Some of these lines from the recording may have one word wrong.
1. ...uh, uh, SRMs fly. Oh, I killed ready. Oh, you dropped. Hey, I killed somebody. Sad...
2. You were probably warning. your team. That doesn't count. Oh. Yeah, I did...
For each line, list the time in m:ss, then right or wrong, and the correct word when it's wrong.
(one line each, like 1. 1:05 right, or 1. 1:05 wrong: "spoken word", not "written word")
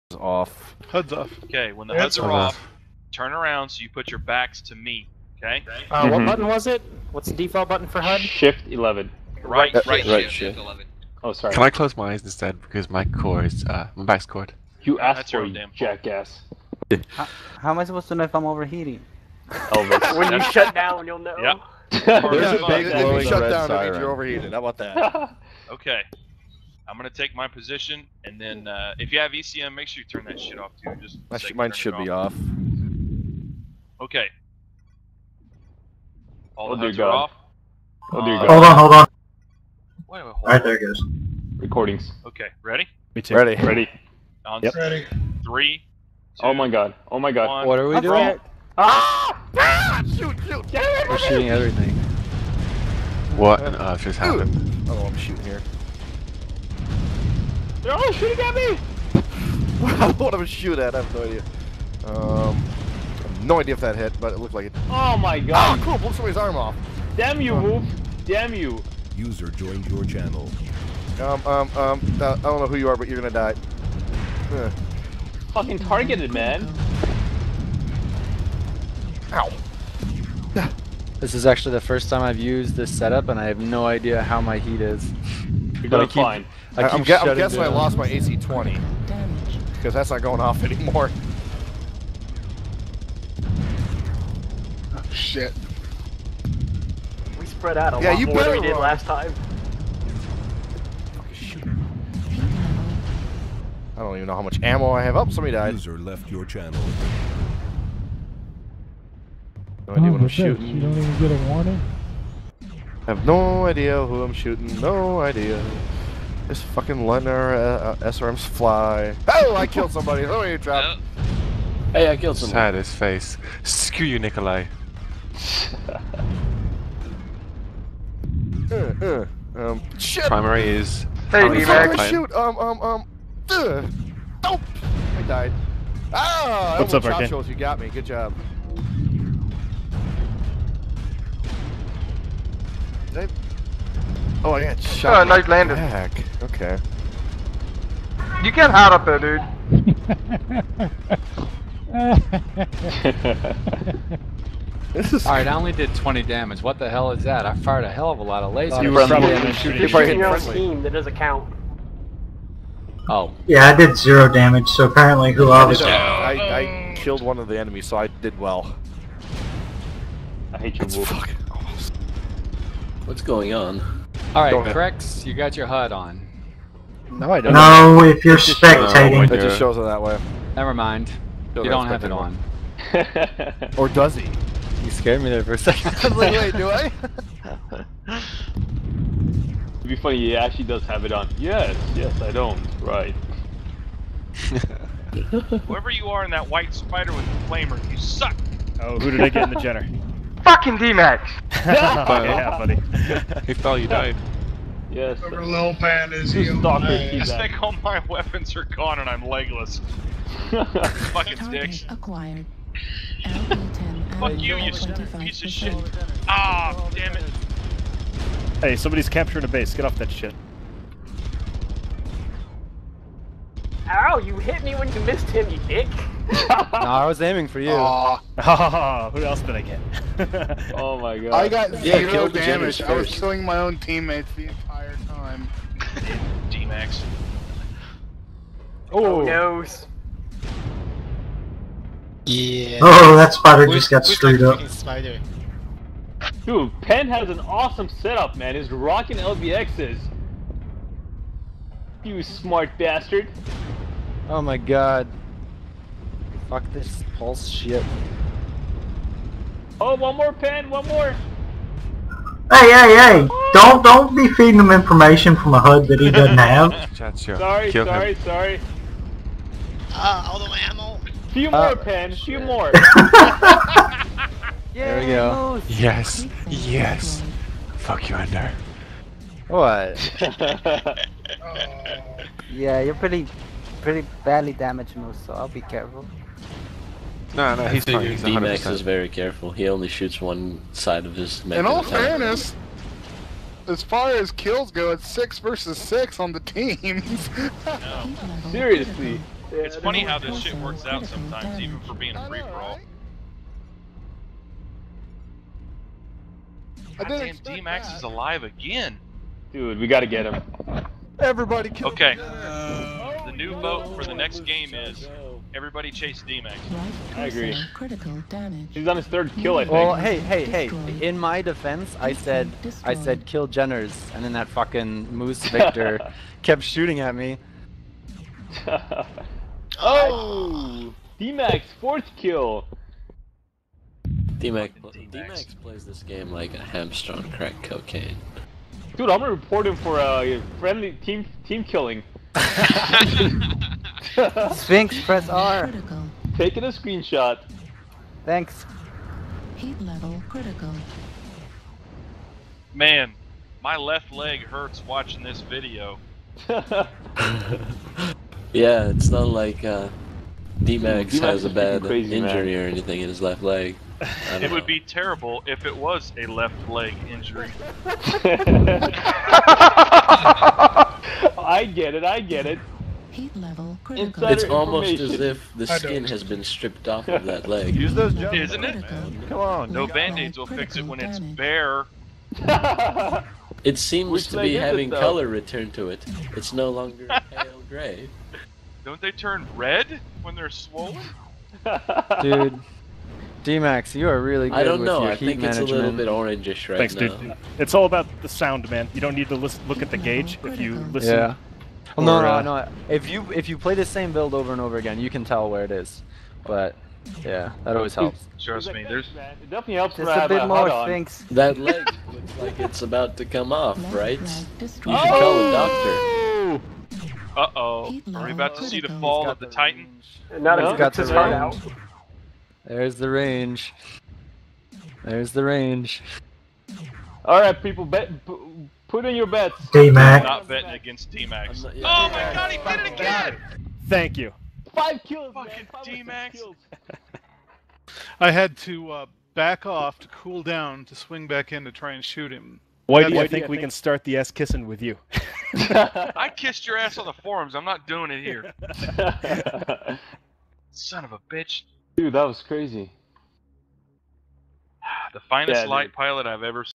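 1. 1:57 wrong: "somebody", not "ready"
2. 2:38 wrong: "shooting", not "warning".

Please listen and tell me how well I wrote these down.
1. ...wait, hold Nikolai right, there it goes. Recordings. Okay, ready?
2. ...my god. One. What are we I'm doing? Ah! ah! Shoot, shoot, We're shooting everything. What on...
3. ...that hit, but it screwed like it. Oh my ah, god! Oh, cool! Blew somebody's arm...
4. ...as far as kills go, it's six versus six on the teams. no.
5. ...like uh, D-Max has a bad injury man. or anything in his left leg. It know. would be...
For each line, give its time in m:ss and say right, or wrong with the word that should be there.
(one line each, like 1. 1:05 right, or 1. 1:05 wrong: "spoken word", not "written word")
1. 0:40 wrong: "All", not "Nikolai"
2. 0:47 right
3. 1:03 wrong: "looked", not "screwed"
4. 4:53 right
5. 5:59 right.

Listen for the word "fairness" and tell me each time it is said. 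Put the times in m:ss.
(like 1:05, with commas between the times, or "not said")
4:51.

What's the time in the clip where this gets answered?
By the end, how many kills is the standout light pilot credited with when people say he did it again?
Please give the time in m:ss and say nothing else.
7:14.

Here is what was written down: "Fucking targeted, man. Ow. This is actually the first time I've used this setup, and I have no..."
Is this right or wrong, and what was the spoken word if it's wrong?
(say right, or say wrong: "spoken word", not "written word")
right.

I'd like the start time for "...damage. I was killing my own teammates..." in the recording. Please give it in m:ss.
3:52.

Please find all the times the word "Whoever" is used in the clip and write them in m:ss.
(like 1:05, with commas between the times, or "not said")
3:15, 3:25.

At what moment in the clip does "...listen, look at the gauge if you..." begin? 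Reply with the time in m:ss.
6:39.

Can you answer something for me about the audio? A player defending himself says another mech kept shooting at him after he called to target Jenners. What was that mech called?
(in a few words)
Moose Victor.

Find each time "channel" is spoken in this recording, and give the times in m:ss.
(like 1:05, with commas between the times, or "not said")
1:10, 1:46.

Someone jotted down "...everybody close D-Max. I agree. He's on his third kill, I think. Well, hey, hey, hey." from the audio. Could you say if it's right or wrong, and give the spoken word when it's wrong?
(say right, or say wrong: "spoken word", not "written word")
wrong: "chase", not "close".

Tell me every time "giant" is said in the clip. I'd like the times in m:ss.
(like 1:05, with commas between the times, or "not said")
not said.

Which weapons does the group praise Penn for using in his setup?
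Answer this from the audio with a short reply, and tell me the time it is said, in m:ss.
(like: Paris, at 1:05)
LBXs, at 4:09.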